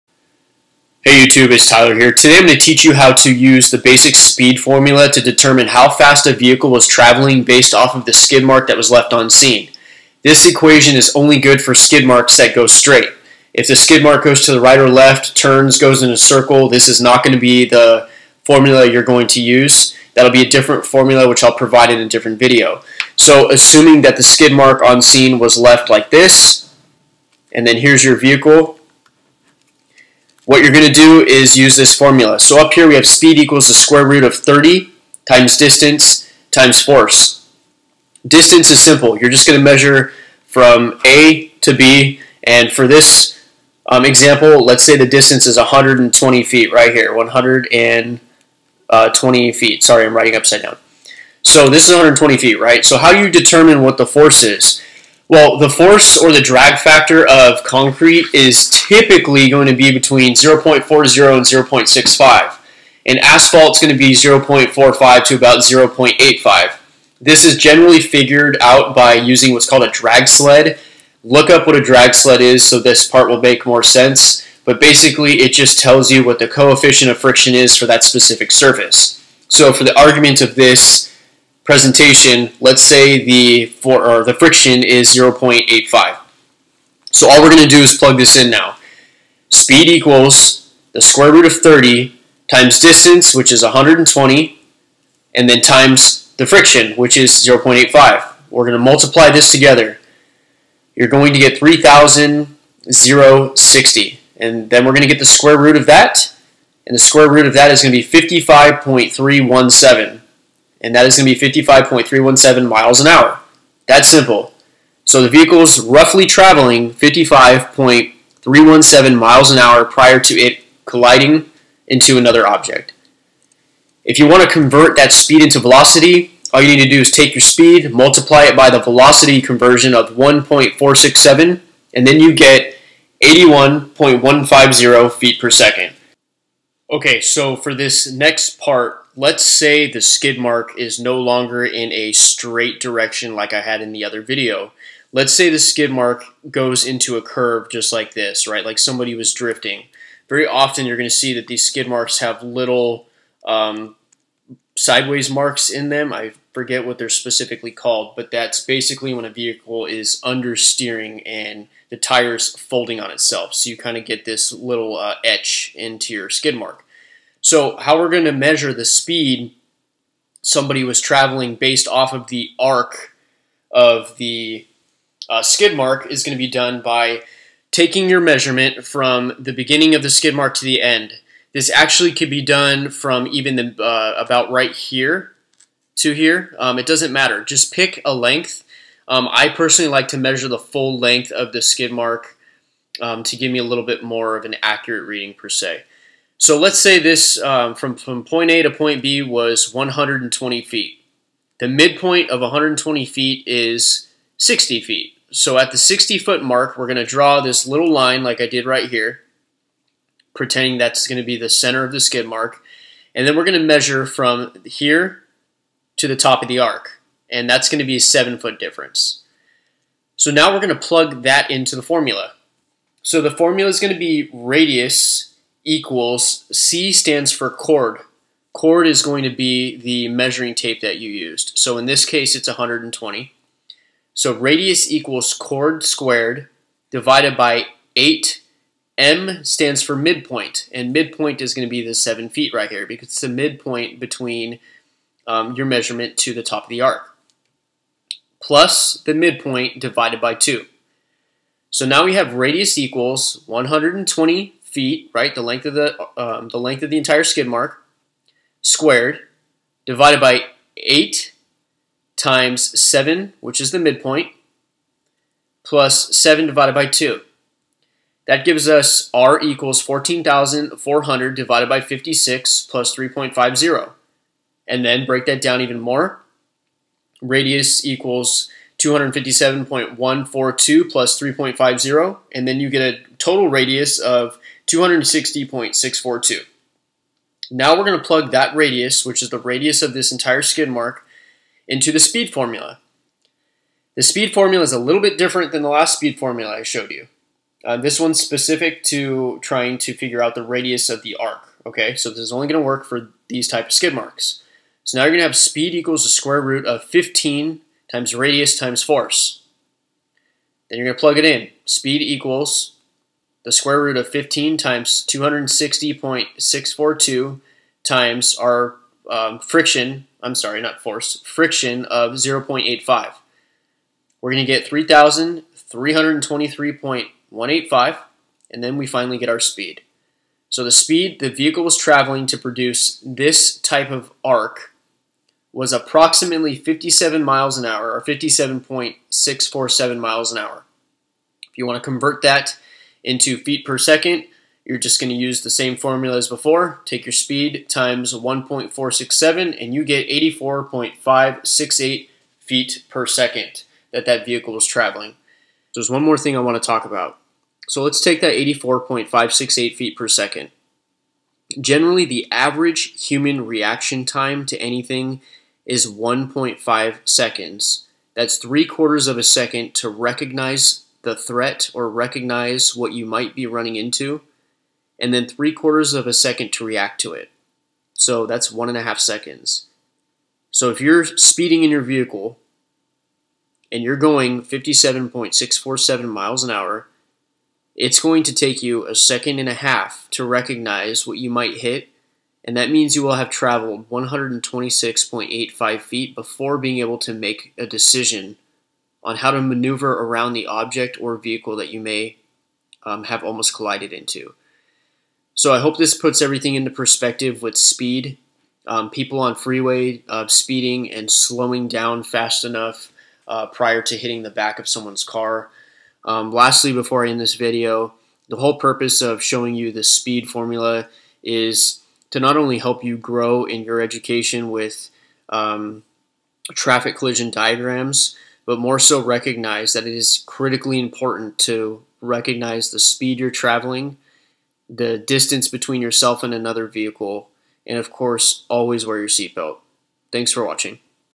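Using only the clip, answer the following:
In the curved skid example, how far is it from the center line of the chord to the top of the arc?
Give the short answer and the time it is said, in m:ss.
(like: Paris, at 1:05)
7 feet, at 3:38.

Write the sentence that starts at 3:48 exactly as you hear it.
Chord is going to be the measuring tape that you used.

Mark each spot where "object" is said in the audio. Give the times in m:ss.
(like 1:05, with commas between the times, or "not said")
2:02, 6:40.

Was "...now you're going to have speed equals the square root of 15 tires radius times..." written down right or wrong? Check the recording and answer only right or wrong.
wrong.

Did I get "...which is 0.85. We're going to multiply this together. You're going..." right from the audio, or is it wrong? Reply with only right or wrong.
right.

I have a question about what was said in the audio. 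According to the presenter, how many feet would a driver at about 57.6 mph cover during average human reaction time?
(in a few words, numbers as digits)
126.85 feet.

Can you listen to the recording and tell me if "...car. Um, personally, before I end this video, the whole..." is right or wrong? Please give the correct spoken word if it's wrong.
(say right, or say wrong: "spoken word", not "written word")
wrong: "lastly", not "personally".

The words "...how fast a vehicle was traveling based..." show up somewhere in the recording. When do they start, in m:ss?
0:05.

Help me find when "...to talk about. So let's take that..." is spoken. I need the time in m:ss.
5:56.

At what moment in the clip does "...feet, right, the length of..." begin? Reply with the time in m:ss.
4:14.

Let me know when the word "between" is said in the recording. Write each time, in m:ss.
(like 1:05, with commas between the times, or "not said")
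0:59, 4:03, 7:15.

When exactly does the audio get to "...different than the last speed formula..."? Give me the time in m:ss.
4:55.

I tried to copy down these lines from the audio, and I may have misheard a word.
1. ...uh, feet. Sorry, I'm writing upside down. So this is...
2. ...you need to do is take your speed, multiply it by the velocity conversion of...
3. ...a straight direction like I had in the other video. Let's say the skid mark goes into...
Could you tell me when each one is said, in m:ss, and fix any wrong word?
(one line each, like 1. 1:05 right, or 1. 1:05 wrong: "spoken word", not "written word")
1. 0:48 right
2. 2:06 right
3. 2:21 right.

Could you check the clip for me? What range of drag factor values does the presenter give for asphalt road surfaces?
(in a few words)
0.45 to 0.85.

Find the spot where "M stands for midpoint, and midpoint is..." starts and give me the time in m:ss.
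3:58.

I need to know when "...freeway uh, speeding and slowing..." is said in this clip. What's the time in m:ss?
6:49.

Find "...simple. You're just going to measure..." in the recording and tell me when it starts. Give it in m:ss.
0:38.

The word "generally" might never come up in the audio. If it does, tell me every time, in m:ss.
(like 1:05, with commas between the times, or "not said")
1:07, 6:01.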